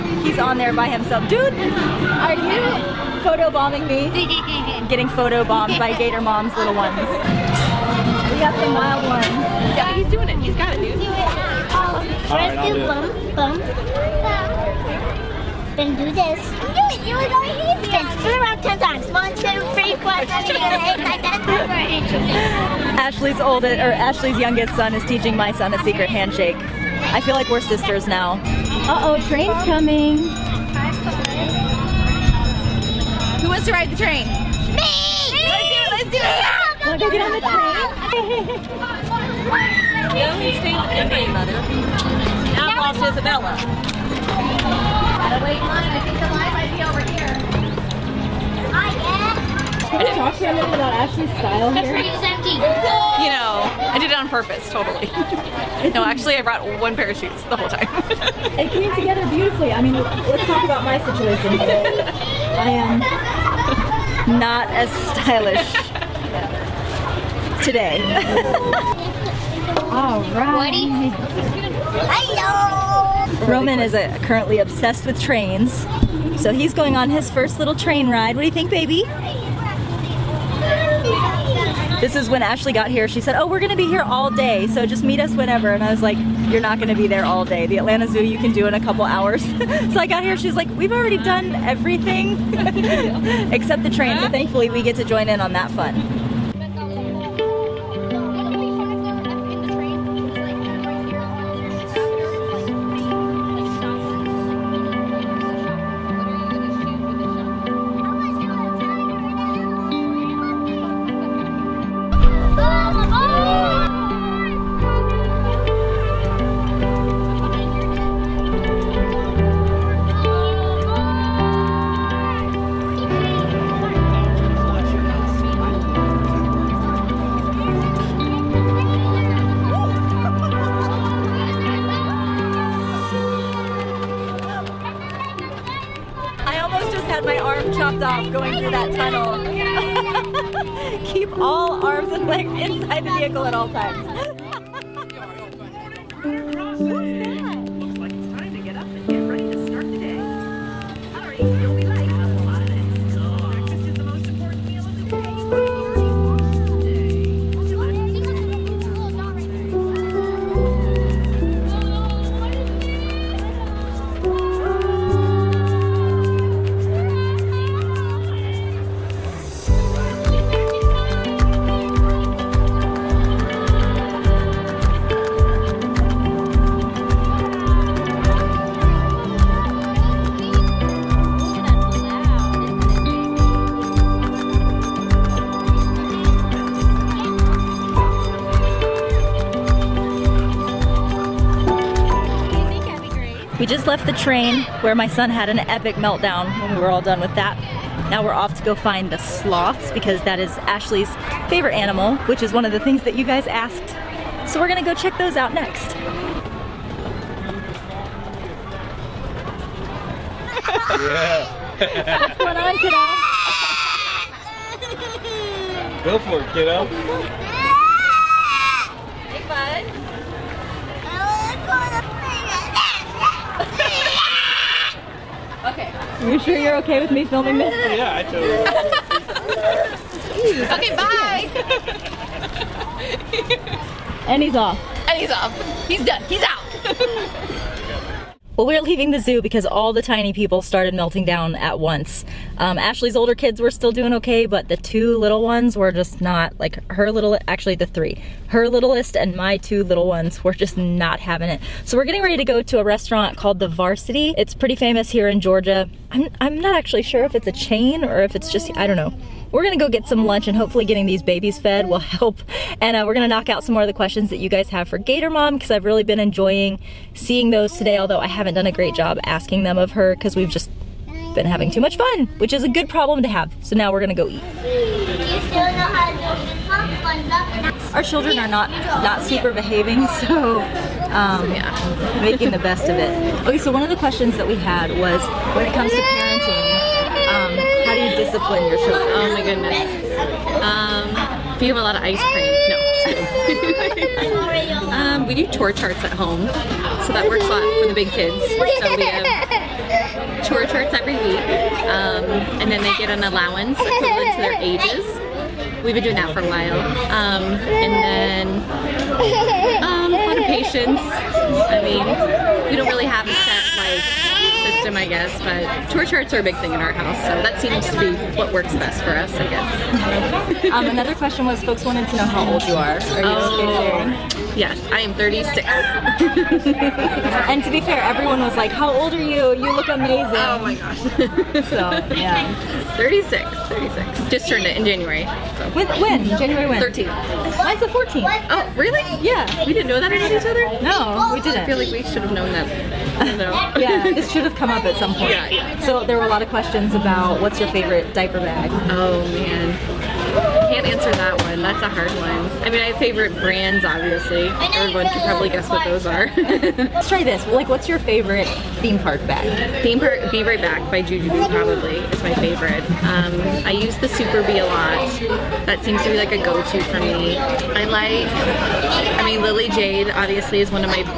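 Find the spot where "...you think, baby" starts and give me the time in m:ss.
1:18.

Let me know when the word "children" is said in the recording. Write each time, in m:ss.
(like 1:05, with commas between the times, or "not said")
4:38, 4:48.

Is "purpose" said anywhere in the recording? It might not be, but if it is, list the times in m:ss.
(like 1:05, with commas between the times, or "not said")
0:54.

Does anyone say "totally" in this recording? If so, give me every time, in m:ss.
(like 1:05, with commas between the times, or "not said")
0:54, 3:48.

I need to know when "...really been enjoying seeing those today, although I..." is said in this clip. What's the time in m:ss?
4:25.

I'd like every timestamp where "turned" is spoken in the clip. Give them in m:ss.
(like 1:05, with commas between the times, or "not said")
5:34.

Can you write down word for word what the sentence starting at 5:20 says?
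um, another question was, folks wanted to know how old you are.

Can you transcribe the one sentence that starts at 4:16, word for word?
I'm, I'm not actually sure if it's a chain or if it's just, I don't know.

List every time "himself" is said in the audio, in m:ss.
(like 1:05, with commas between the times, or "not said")
0:00.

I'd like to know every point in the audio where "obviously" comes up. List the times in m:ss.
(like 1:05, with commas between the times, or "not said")
5:53, 6:10.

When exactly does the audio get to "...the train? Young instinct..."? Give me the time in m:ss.
0:37.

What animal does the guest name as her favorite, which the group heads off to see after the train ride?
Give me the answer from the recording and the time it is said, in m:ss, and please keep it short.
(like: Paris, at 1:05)
Sloths, at 3:19.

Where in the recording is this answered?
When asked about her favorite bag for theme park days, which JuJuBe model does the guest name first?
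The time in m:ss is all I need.
6:00.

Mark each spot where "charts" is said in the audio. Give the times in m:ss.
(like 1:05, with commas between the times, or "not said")
4:55, 5:00, 5:16.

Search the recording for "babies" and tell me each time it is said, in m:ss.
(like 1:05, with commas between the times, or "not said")
4:21.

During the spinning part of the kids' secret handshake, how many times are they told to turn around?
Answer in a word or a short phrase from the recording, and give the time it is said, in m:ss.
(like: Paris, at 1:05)
10, at 0:18.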